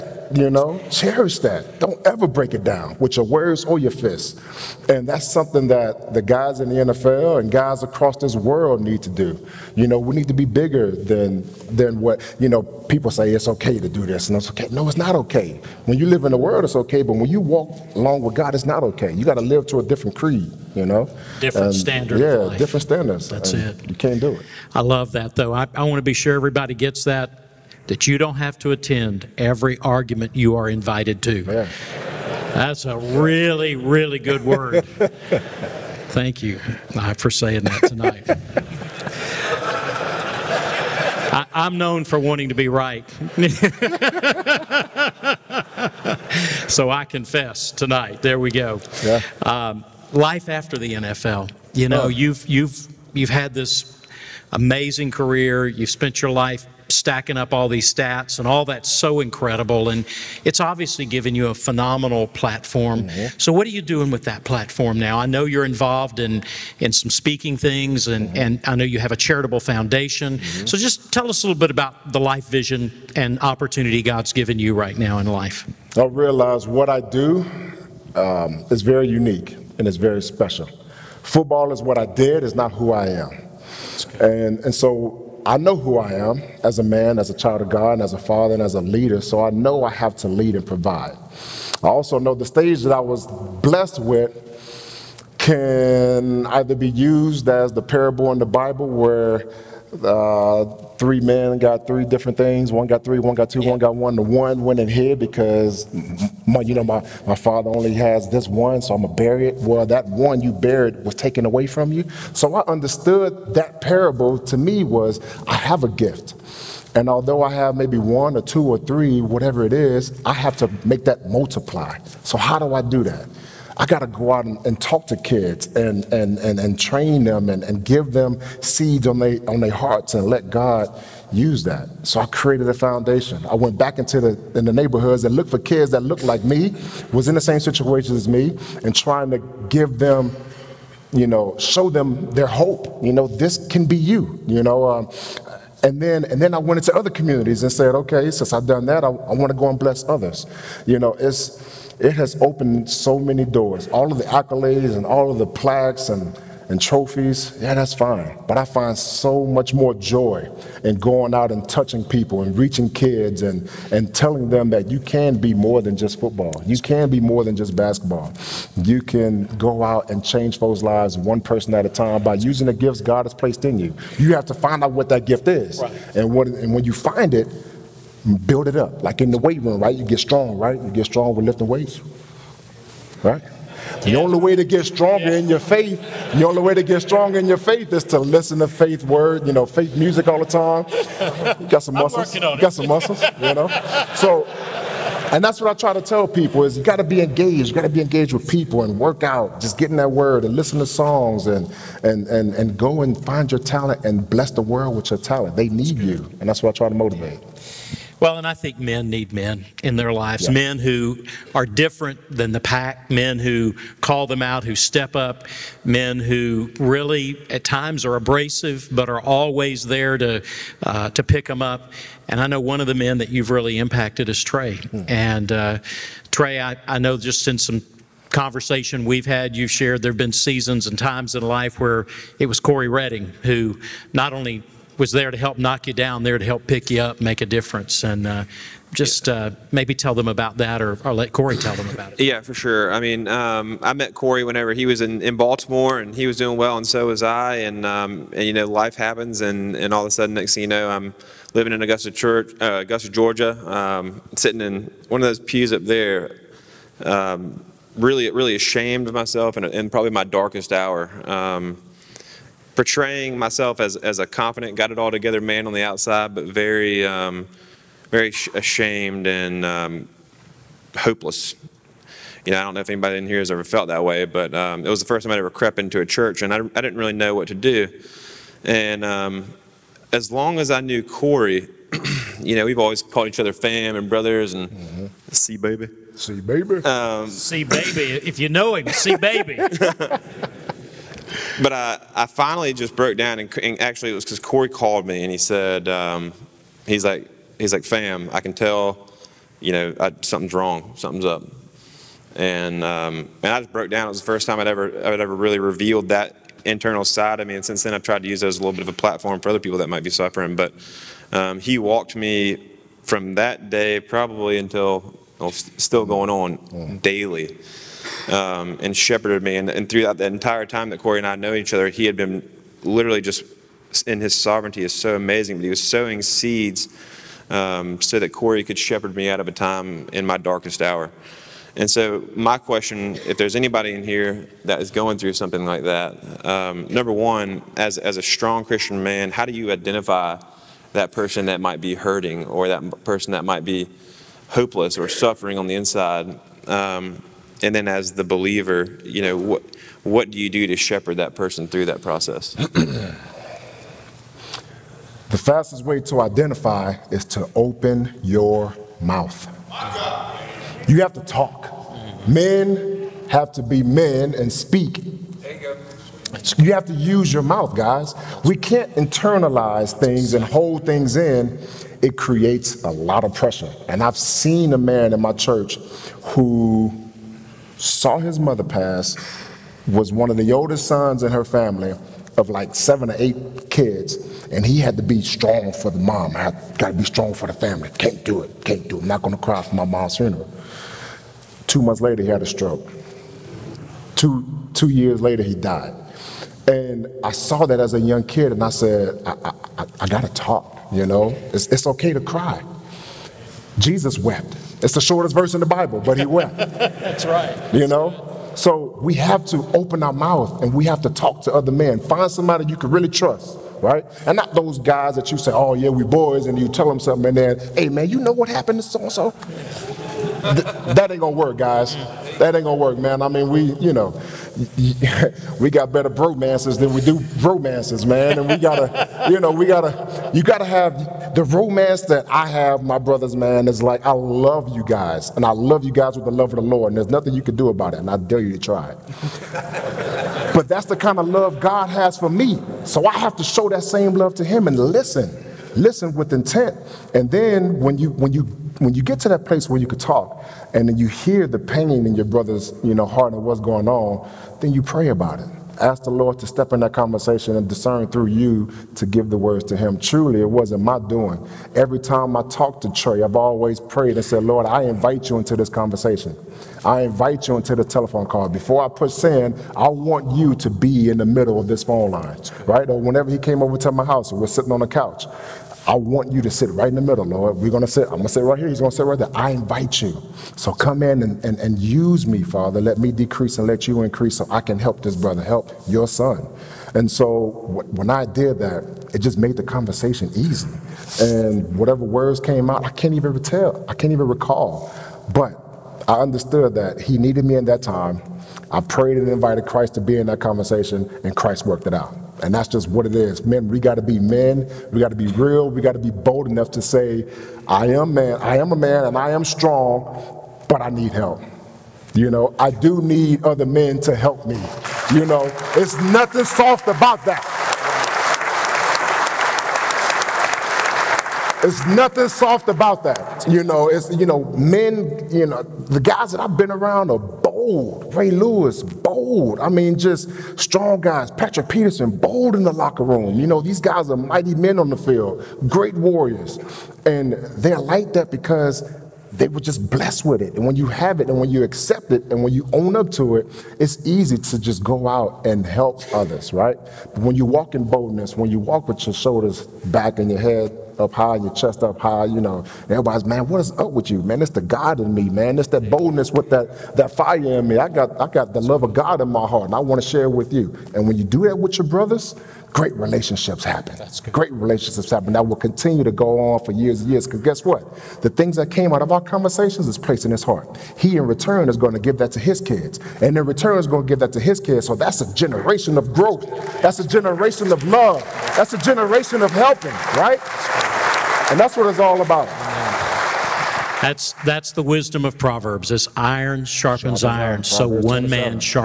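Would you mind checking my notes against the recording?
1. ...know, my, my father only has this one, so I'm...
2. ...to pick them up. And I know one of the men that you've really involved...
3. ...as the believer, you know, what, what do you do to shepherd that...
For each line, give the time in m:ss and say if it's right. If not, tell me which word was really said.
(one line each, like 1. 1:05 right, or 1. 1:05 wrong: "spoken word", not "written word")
1. 1:46 right
2. 3:41 wrong: "impacted", not "involved"
3. 5:47 right.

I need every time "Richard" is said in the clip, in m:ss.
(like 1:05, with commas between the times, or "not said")
not said.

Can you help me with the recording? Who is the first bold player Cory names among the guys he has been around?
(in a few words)
Ray Lewis.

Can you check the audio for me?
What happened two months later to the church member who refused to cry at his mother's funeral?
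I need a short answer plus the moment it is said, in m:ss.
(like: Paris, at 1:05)
He had a stroke, at 6:32.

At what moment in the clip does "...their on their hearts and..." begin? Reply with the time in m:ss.
2:09.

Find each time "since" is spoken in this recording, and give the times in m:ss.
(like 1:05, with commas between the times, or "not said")
2:28, 5:07.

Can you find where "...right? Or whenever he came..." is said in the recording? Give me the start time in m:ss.
7:52.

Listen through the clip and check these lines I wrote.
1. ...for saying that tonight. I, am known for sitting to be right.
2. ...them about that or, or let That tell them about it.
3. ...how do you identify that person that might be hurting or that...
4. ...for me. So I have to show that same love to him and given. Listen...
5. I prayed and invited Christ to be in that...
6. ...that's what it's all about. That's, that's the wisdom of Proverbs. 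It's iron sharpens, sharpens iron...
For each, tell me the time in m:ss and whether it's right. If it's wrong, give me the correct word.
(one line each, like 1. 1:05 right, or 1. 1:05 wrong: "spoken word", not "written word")
1. 0:37 wrong: "wanting", not "sitting"
2. 4:00 wrong: "Cory", not "That"
3. 5:39 right
4. 7:22 wrong: "listen", not "given"
5. 8:18 right
6. 9:41 right.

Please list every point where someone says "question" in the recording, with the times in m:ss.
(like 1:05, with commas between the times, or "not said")
5:32.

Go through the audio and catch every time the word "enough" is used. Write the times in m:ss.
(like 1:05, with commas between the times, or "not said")
8:26.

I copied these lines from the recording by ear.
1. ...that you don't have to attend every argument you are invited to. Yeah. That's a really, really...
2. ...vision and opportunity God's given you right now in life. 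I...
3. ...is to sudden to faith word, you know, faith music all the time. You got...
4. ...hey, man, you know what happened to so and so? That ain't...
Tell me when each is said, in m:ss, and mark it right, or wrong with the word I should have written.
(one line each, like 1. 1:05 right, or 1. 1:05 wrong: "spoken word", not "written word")
1. 0:27 right
2. 1:12 right
3. 3:07 wrong: "listen", not "sudden"
4. 6:57 right.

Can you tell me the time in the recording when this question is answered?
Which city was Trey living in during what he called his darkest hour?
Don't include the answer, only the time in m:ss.
4:12.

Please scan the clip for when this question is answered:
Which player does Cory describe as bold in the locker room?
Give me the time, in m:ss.
8:51.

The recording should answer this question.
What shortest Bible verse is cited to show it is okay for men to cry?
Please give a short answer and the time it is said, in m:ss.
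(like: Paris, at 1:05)
Jesus wept, at 6:43.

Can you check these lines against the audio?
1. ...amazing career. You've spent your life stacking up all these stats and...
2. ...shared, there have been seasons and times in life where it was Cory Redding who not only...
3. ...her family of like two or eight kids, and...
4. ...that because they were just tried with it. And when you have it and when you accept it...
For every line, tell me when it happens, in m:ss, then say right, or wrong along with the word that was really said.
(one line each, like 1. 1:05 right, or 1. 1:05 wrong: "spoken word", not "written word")
1. 0:54 right
2. 3:49 right
3. 6:21 wrong: "seven", not "two"
4. 8:58 wrong: "blessed", not "tried".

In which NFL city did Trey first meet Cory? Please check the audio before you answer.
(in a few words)
Baltimore.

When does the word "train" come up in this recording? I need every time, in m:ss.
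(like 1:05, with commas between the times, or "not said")
2:06.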